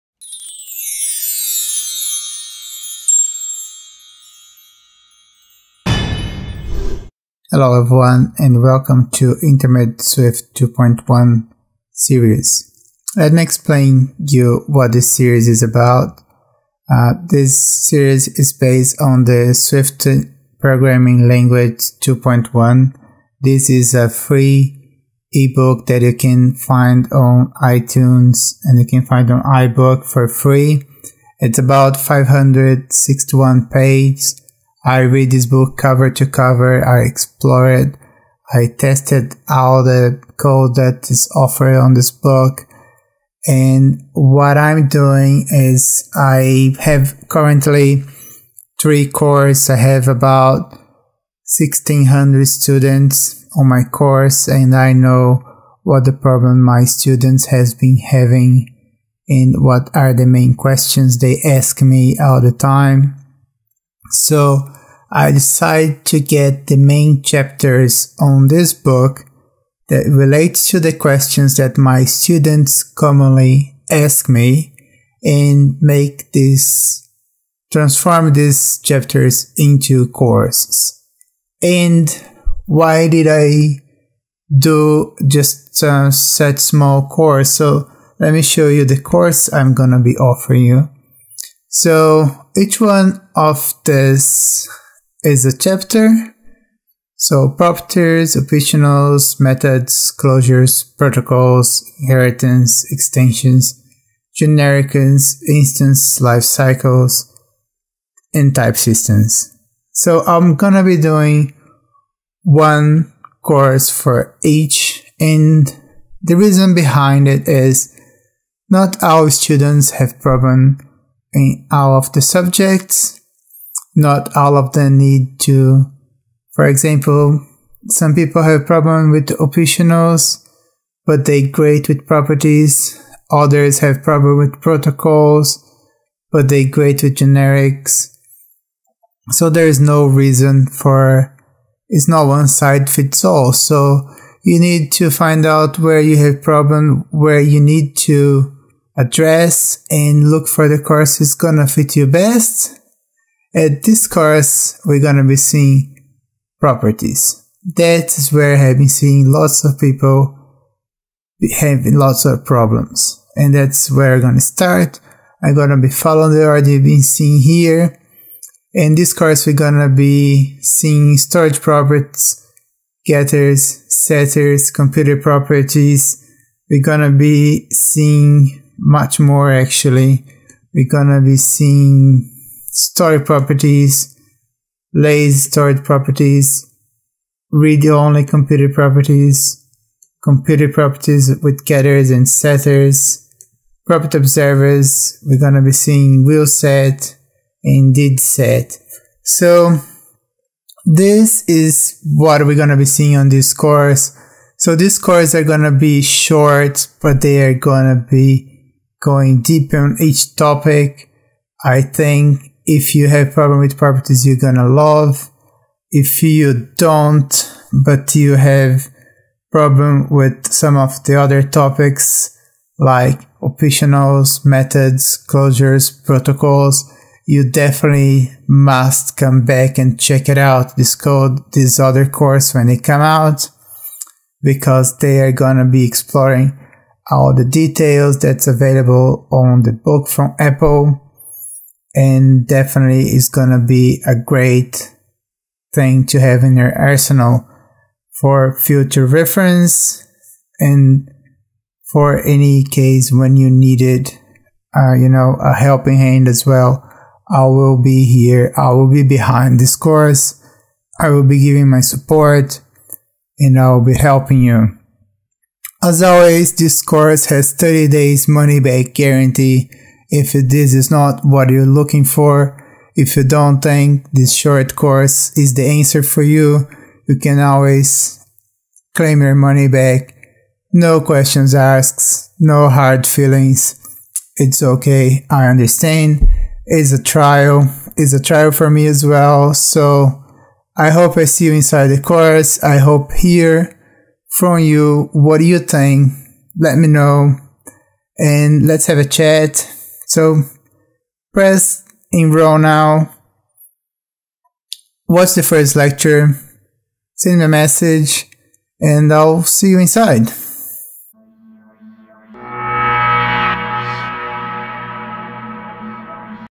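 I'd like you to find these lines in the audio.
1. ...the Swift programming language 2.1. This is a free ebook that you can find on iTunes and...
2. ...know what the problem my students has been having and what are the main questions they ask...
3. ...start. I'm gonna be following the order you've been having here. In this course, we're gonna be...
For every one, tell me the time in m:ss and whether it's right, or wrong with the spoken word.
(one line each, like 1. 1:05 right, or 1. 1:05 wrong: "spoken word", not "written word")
1. 0:19 right
2. 0:54 right
3. 2:44 wrong: "seeing", not "having".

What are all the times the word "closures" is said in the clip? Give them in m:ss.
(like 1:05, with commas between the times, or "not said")
1:40, 3:45.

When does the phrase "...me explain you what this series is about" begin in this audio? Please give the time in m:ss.
0:13.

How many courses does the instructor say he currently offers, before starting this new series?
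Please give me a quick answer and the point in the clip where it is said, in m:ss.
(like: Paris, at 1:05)
3, at 0:48.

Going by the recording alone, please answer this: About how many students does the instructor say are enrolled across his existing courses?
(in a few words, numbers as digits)
1600.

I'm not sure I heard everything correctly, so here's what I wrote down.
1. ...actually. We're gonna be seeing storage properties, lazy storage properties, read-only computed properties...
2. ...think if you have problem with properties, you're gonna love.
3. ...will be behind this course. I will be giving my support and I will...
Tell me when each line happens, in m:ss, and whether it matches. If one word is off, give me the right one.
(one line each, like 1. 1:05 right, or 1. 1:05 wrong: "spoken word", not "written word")
1. 2:59 right
2. 3:31 right
3. 4:18 right.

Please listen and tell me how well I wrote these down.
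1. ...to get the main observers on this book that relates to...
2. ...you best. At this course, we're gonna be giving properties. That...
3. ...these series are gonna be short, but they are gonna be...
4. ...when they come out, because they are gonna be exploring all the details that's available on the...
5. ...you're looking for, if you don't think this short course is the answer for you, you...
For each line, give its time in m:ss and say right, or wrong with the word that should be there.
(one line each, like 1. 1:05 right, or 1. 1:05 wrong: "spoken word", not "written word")
1. 1:06 wrong: "chapters", not "observers"
2. 2:31 wrong: "seeing", not "giving"
3. 3:24 wrong: "courses", not "series"
4. 3:52 right
5. 4:31 right.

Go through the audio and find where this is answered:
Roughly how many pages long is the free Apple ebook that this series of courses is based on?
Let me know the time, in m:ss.
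0:31.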